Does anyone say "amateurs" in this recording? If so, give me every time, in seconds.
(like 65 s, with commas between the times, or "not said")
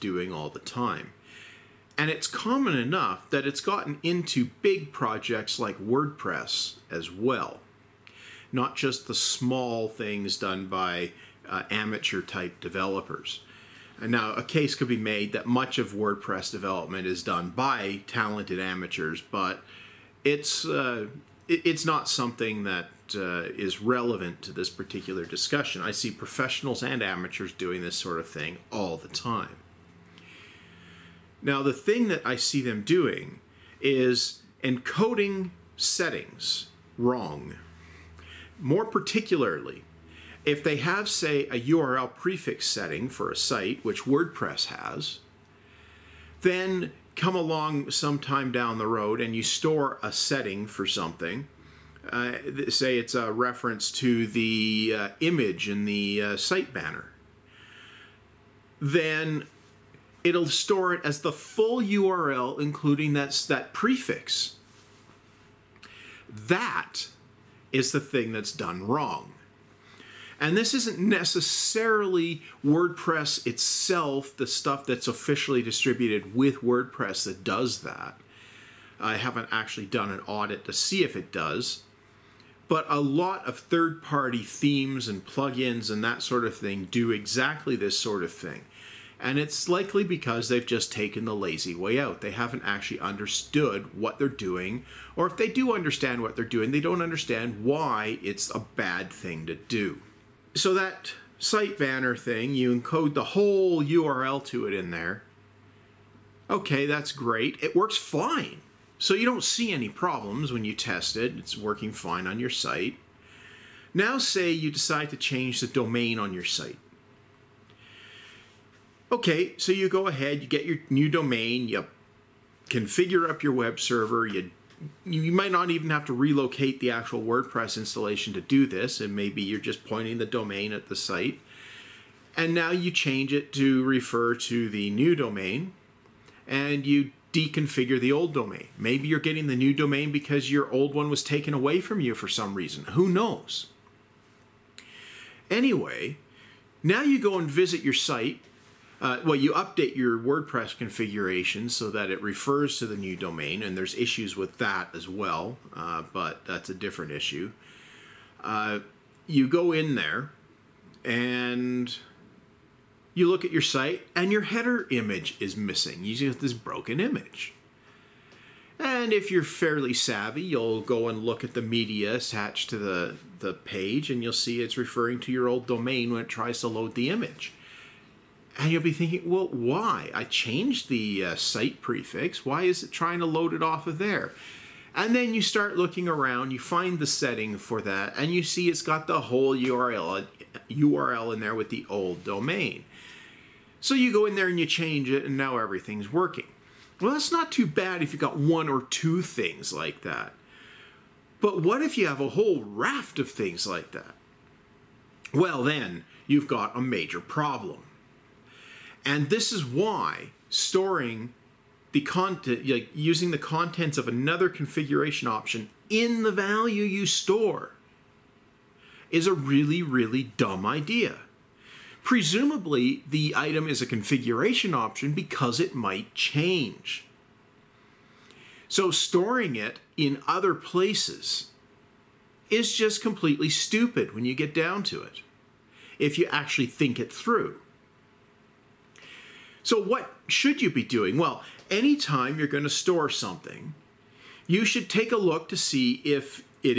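11 s, 18 s, 27 s.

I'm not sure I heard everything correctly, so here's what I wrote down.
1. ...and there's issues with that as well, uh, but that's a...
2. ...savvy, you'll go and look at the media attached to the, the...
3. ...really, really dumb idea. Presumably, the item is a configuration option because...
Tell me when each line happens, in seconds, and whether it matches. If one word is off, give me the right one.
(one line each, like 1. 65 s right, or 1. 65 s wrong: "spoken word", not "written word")
1. 153 s right
2. 169 s right
3. 219 s right.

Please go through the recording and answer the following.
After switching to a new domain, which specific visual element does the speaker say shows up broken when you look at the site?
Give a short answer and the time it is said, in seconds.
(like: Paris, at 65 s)
header image, at 164 s.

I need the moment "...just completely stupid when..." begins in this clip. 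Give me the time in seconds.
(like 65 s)
232 s.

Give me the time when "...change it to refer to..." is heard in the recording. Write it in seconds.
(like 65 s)
132 s.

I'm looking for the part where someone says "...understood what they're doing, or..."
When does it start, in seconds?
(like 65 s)
92 s.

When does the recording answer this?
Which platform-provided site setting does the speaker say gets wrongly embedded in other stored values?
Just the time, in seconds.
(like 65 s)
41 s.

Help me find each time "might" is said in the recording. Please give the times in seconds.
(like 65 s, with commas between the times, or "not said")
125 s, 225 s.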